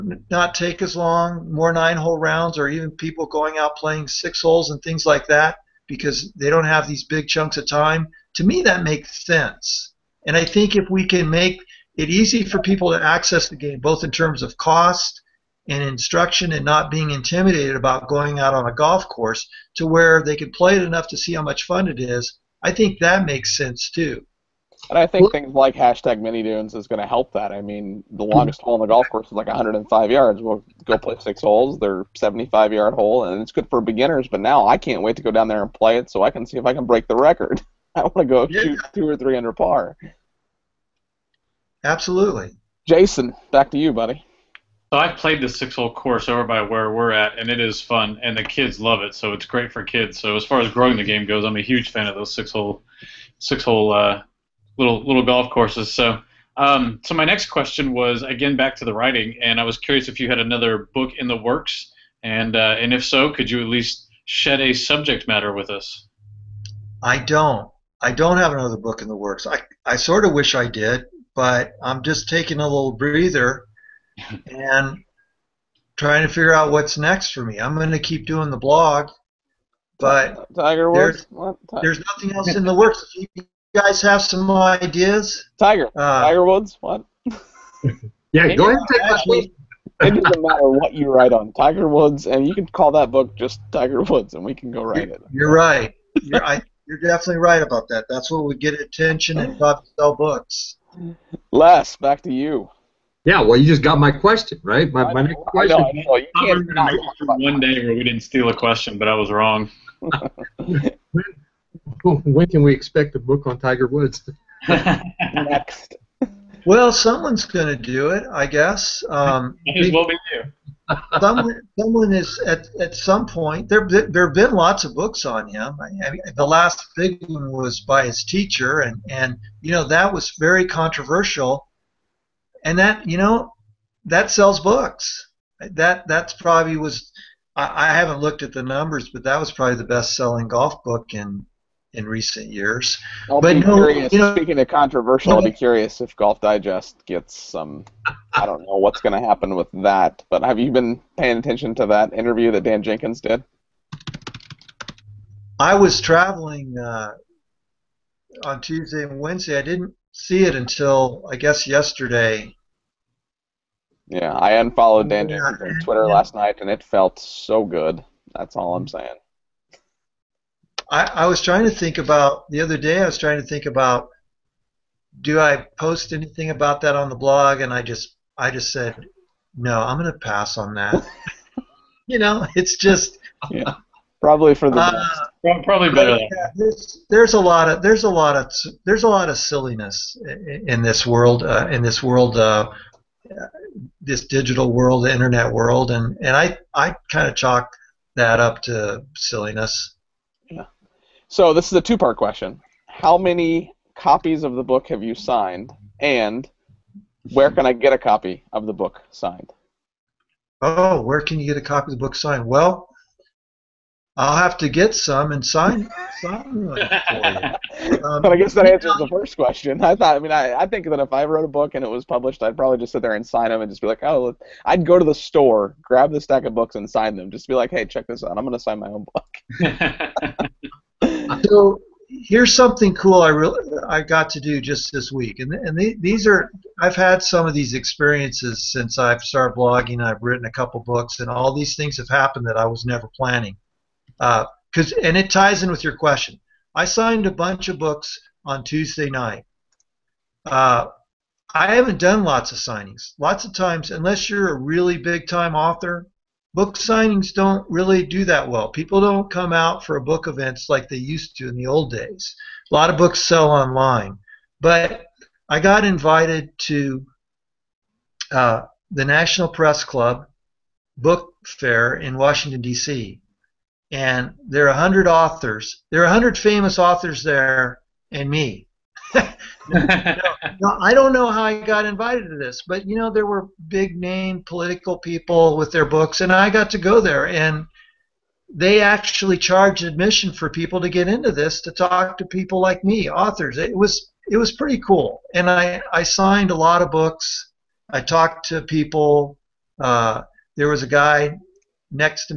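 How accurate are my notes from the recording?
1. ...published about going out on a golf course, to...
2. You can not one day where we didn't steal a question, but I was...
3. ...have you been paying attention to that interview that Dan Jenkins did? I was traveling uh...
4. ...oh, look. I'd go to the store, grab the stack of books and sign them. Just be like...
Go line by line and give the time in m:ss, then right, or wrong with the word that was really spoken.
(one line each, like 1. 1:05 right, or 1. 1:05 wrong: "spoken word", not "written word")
1. 0:17 wrong: "intimidated", not "published"
2. 1:46 right
3. 2:30 right
4. 3:44 right.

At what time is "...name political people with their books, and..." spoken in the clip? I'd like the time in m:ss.
4:43.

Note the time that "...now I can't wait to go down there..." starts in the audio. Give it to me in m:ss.
0:34.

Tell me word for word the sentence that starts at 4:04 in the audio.
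Because uh, and it ties in with your question.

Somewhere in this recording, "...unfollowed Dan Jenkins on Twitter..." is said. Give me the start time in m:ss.
2:44.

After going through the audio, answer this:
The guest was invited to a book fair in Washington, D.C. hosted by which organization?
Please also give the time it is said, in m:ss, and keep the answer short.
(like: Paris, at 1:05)
National Press Club, at 4:29.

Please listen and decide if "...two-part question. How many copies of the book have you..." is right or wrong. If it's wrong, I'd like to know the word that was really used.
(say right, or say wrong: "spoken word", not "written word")
right.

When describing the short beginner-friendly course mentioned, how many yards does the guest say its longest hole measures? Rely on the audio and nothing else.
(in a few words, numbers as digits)
105 yards.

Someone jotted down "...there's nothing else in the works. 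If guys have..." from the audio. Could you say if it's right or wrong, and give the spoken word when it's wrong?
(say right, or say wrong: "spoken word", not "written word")
right.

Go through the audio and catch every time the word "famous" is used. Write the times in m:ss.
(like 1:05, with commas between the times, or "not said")
4:36.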